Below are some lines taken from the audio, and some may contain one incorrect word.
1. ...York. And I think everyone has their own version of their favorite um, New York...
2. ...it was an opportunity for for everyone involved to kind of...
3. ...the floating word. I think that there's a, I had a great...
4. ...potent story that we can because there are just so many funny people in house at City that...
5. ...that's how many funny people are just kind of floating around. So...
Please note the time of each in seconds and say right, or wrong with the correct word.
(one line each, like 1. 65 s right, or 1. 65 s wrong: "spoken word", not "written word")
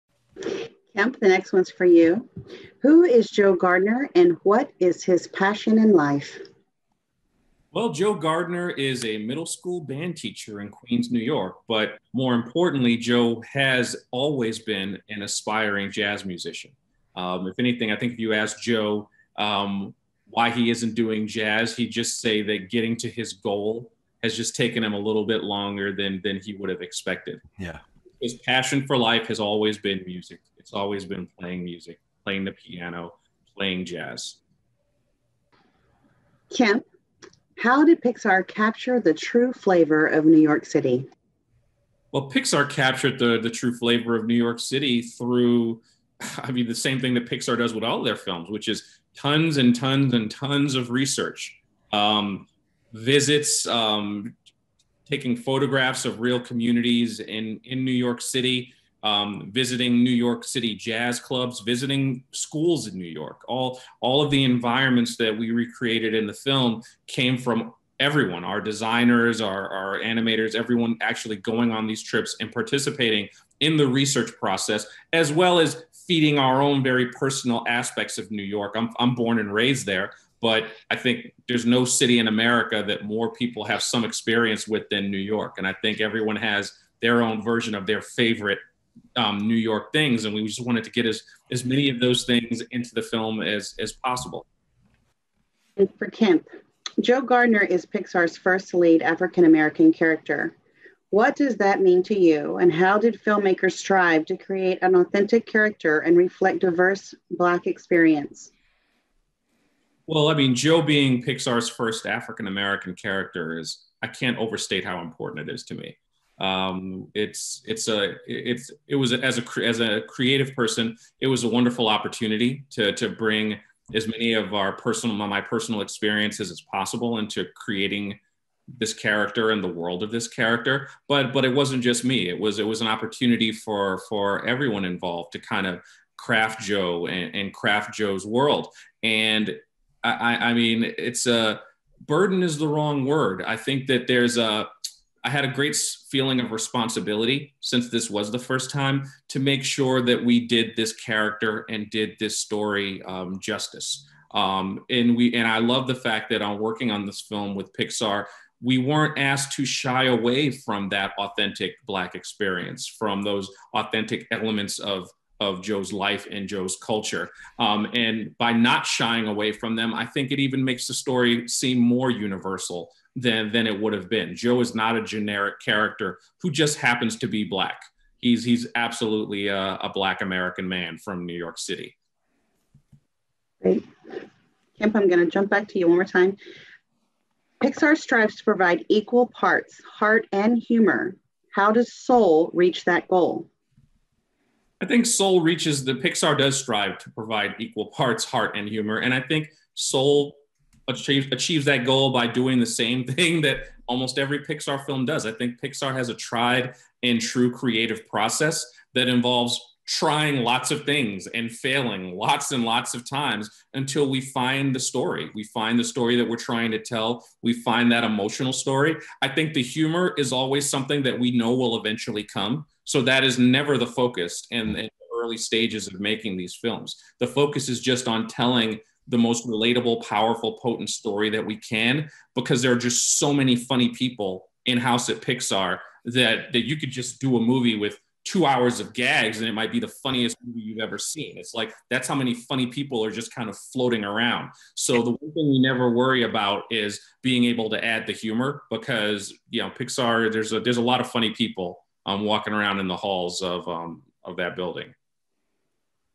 1. 85 s right
2. 132 s right
3. 142 s wrong: "wrong", not "floating"
4. 230 s wrong: "Pixar", not "City"
5. 241 s right.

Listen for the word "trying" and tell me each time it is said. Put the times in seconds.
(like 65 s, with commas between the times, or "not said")
209 s, 216 s.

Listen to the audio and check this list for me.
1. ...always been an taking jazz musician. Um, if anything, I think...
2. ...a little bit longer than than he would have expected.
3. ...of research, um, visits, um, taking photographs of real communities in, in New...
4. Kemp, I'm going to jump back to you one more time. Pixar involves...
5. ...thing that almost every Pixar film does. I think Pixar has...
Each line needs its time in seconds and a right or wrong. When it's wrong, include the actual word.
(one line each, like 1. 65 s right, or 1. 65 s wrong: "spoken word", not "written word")
1. 14 s wrong: "aspiring", not "taking"
2. 24 s right
3. 50 s right
4. 184 s wrong: "strives", not "involves"
5. 203 s right.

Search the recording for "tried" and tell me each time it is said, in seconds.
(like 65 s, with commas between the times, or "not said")
206 s.